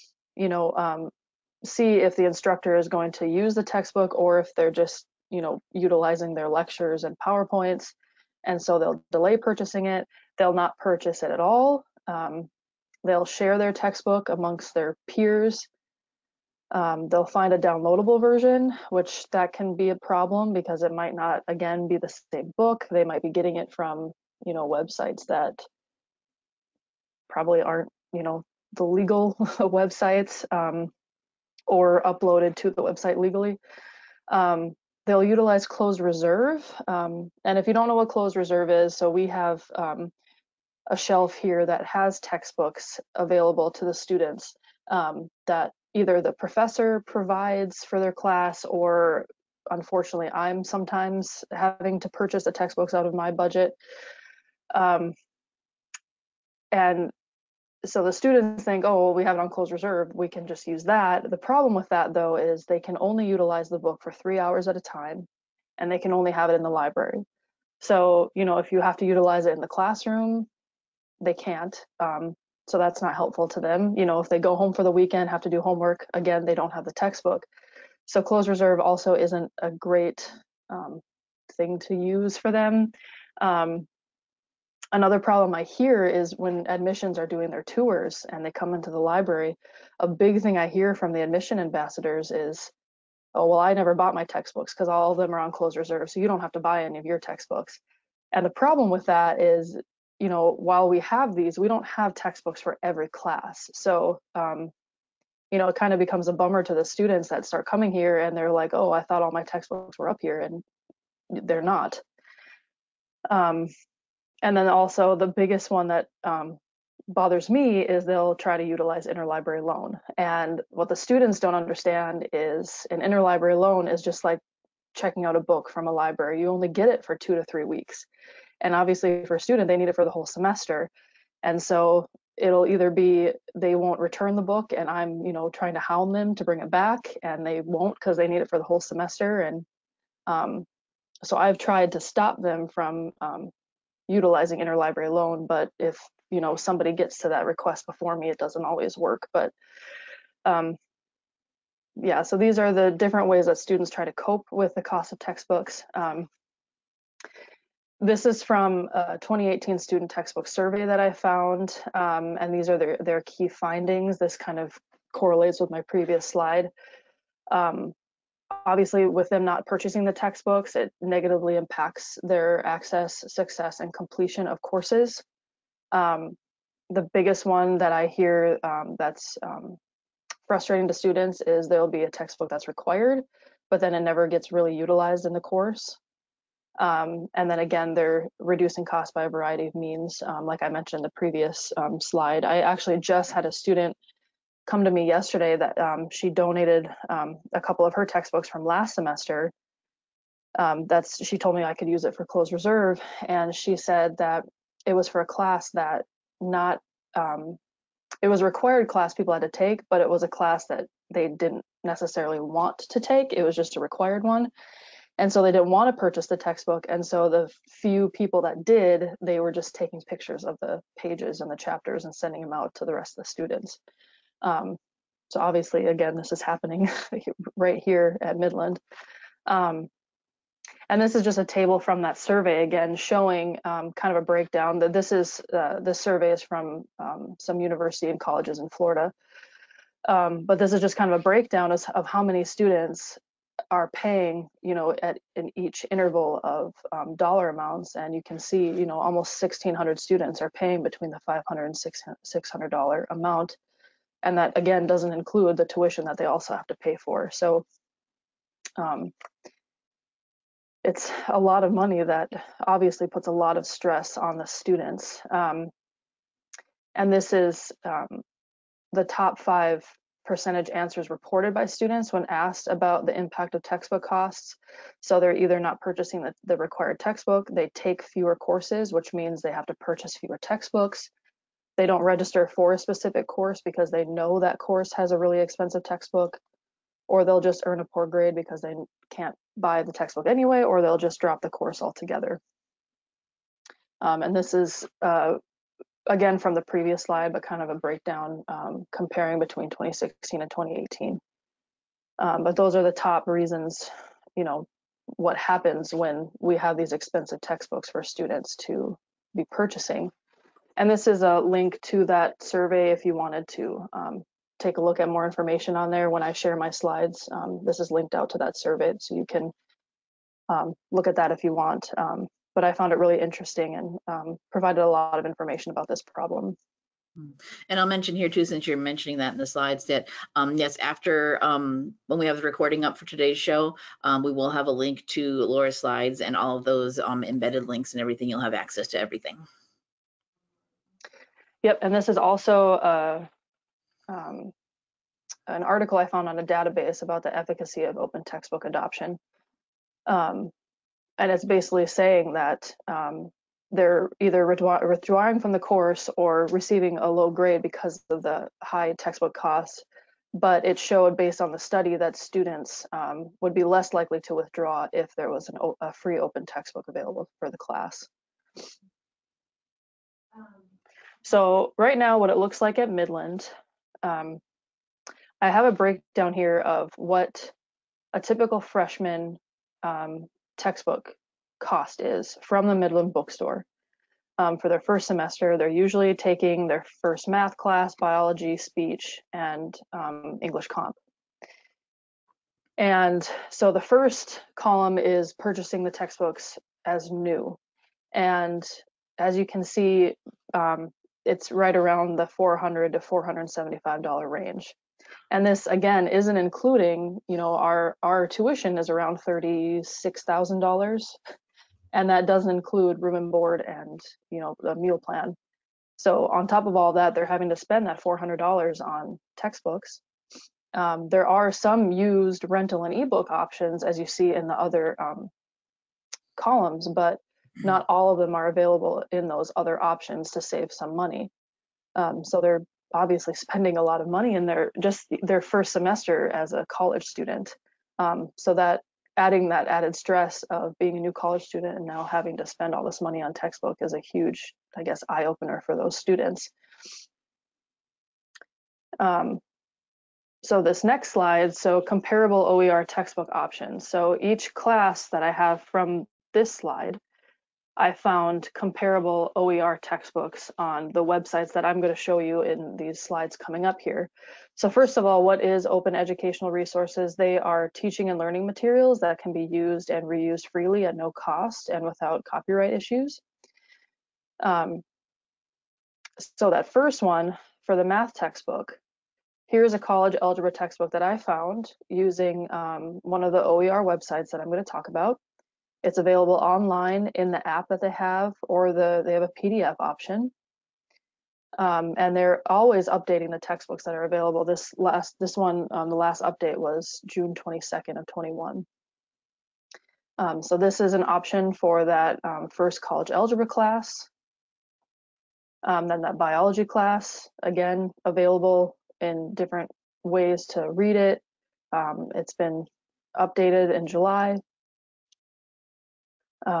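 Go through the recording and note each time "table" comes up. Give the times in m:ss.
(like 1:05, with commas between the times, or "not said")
3:51.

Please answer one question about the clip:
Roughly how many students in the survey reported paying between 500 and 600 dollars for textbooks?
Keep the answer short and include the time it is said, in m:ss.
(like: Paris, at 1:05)
1,600, at 4:09.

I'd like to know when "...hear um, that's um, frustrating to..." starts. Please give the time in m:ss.
2:58.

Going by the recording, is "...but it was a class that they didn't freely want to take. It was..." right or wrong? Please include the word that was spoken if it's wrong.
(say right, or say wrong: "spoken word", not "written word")
wrong: "necessarily", not "freely".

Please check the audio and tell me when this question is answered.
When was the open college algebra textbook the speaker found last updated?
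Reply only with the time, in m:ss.
8:17.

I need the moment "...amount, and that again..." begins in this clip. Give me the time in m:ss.
4:13.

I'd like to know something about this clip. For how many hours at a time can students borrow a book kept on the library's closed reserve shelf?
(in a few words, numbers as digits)
3.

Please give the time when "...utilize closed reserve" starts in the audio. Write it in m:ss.
0:35.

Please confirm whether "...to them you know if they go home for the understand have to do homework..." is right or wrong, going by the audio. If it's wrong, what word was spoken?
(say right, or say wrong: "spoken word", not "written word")
wrong: "weekend", not "understand".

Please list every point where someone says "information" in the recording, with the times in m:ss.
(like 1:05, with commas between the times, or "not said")
5:15, 5:25.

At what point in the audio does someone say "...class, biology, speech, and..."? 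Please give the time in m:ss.
6:27.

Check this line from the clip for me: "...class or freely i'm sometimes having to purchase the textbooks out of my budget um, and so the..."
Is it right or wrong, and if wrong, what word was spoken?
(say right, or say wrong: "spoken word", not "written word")
wrong: "unfortunately", not "freely".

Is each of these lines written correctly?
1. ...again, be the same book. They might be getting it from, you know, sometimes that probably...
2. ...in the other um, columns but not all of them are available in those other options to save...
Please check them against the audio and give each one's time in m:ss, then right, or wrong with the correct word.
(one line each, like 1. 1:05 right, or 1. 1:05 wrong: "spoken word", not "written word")
1. 0:21 wrong: "websites", not "sometimes"
2. 7:04 right.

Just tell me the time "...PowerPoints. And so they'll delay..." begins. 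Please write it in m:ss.
0:07.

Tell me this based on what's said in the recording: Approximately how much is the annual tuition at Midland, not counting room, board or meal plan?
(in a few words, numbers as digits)
$36,000.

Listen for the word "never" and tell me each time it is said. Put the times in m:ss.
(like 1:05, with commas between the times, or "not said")
1:33, 3:04.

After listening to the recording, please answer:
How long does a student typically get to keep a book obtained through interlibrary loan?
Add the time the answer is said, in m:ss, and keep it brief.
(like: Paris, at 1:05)
2 to 3 weeks, at 2:07.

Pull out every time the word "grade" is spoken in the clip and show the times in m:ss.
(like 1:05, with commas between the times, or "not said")
4:48, 5:57.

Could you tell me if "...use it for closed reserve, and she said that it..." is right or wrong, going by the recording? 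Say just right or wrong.
right.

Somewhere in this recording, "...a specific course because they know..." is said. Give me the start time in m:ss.
4:42.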